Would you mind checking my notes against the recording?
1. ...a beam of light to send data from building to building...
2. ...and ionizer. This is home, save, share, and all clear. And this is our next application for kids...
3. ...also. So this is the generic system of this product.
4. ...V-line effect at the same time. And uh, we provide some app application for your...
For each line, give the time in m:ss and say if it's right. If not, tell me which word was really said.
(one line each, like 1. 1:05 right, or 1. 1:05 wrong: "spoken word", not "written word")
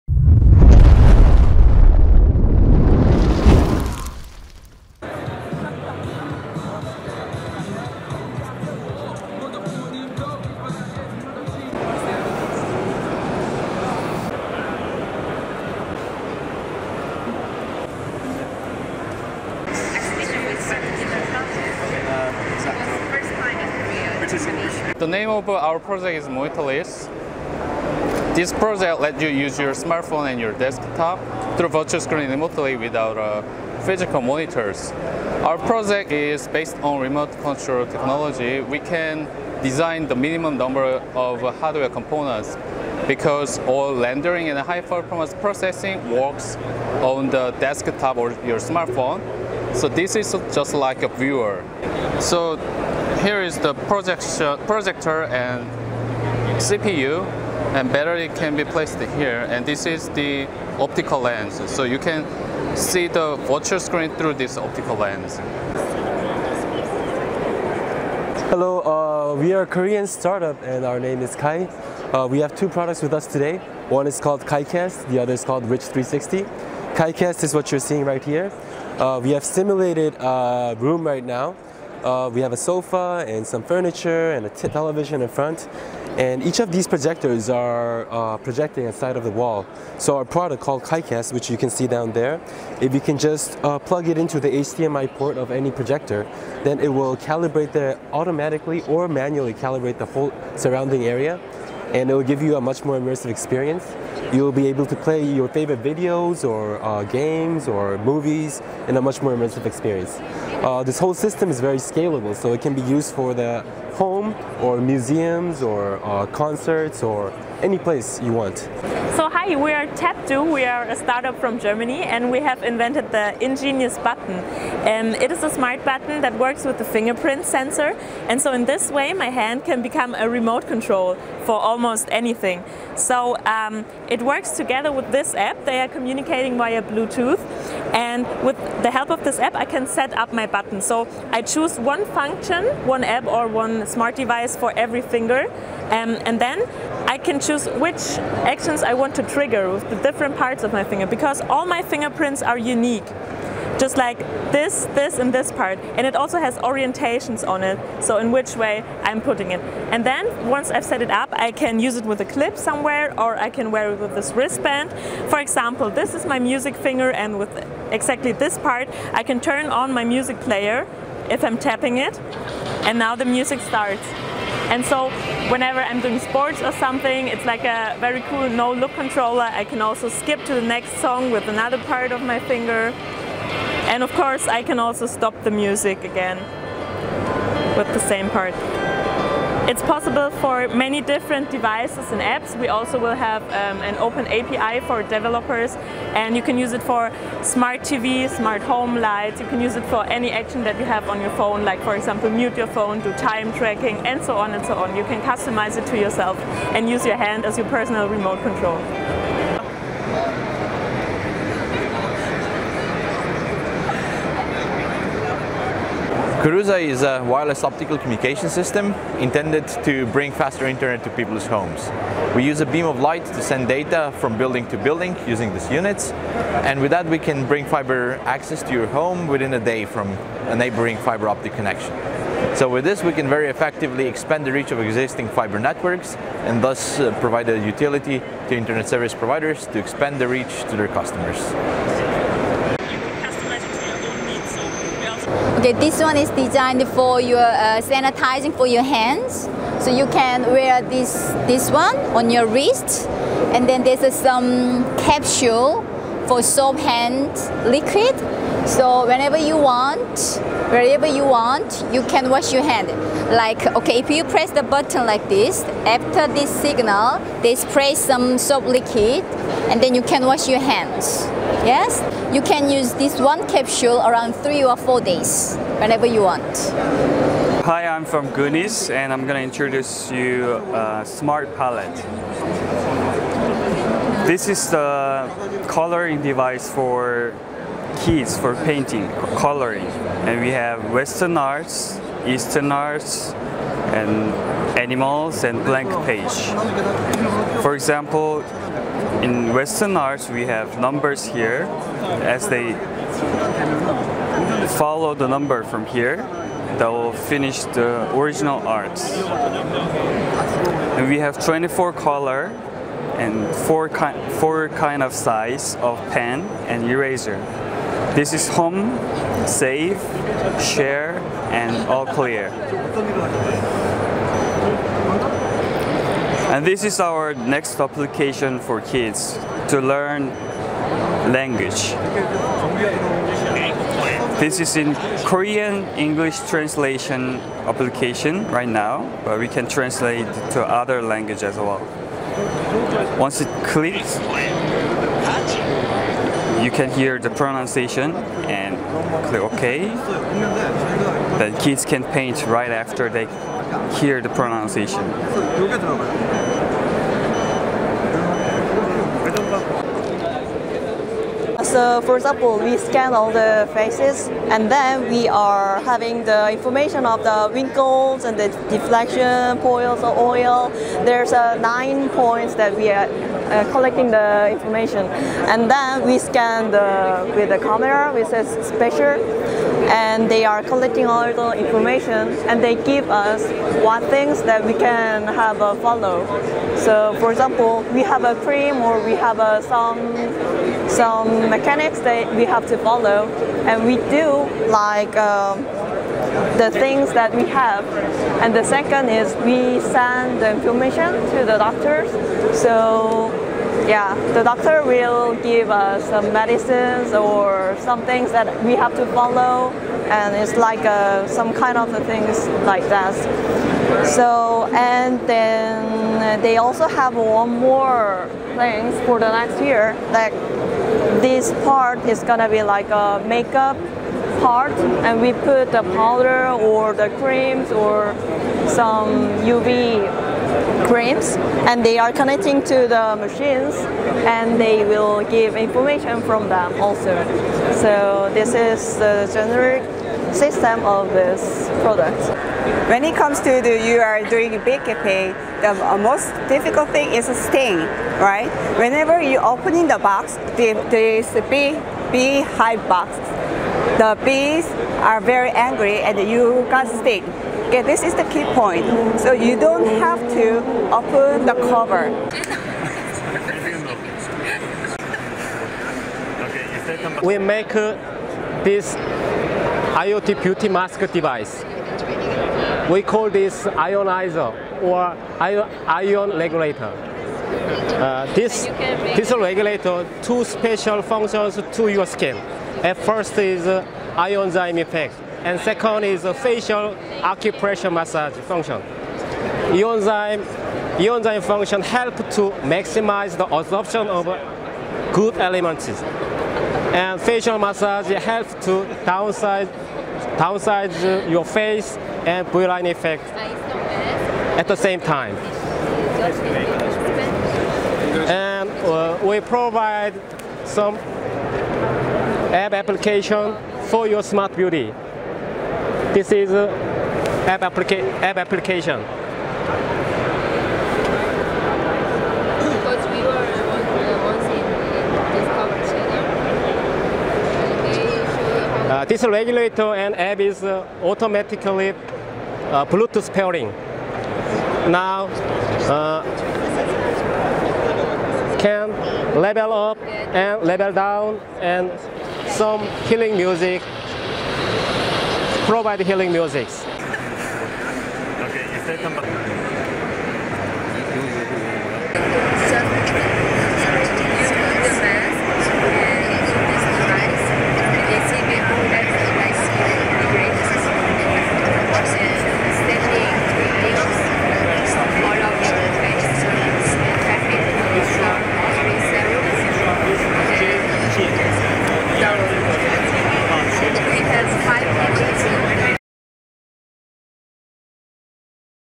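1. 3:42 right
2. 5:16 wrong: "eraser", not "ionizer"
3. 7:16 right
4. 8:22 right.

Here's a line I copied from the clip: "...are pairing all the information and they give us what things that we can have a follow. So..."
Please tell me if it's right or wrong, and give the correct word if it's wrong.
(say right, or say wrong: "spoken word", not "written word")
wrong: "collecting", not "pairing".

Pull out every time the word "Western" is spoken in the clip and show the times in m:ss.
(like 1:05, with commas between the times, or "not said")
4:50, 4:59.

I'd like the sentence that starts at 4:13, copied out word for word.
And then there's uh, some capsule for soap hand liquid.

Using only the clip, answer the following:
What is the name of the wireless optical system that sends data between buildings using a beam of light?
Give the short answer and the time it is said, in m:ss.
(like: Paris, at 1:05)
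Koruza, at 3:36.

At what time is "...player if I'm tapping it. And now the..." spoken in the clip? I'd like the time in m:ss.
2:50.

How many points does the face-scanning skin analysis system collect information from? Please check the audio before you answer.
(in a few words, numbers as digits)
9.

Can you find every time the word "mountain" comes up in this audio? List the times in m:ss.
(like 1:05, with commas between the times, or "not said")
not said.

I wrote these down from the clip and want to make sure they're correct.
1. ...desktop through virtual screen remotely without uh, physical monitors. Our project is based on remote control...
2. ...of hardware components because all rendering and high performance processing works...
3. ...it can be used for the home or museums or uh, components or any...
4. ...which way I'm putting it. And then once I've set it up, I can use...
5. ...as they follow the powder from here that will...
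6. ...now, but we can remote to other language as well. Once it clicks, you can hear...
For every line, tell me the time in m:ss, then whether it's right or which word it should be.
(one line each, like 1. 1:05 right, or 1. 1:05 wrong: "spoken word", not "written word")
1. 0:30 right
2. 0:41 right
3. 1:52 wrong: "concerts", not "components"
4. 2:38 right
5. 5:02 wrong: "number", not "powder"
6. 5:38 wrong: "translate", not "remote".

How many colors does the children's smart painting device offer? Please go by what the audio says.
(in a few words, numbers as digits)
24.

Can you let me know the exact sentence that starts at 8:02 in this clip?
At first is uh, ionzyme effect, and second is a facial acupressure massage function.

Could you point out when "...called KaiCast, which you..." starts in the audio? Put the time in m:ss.
1:30.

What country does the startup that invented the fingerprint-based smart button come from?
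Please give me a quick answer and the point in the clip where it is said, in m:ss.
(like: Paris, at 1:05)
Germany, at 2:01.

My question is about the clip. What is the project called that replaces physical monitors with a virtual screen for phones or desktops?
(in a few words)
Monitorless.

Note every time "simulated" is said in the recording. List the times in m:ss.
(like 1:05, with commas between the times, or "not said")
1:19.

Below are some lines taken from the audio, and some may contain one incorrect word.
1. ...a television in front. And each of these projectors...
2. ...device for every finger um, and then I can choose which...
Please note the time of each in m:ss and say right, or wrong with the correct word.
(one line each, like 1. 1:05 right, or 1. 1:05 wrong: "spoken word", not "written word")
1. 1:24 right
2. 2:24 right.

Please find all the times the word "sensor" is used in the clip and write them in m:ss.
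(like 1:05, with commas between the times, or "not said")
2:07.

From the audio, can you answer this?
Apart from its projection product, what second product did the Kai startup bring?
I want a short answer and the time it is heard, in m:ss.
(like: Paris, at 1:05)
Rich360, at 1:15.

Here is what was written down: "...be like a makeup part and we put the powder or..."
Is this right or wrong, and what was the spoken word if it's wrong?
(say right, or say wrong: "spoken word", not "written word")
right.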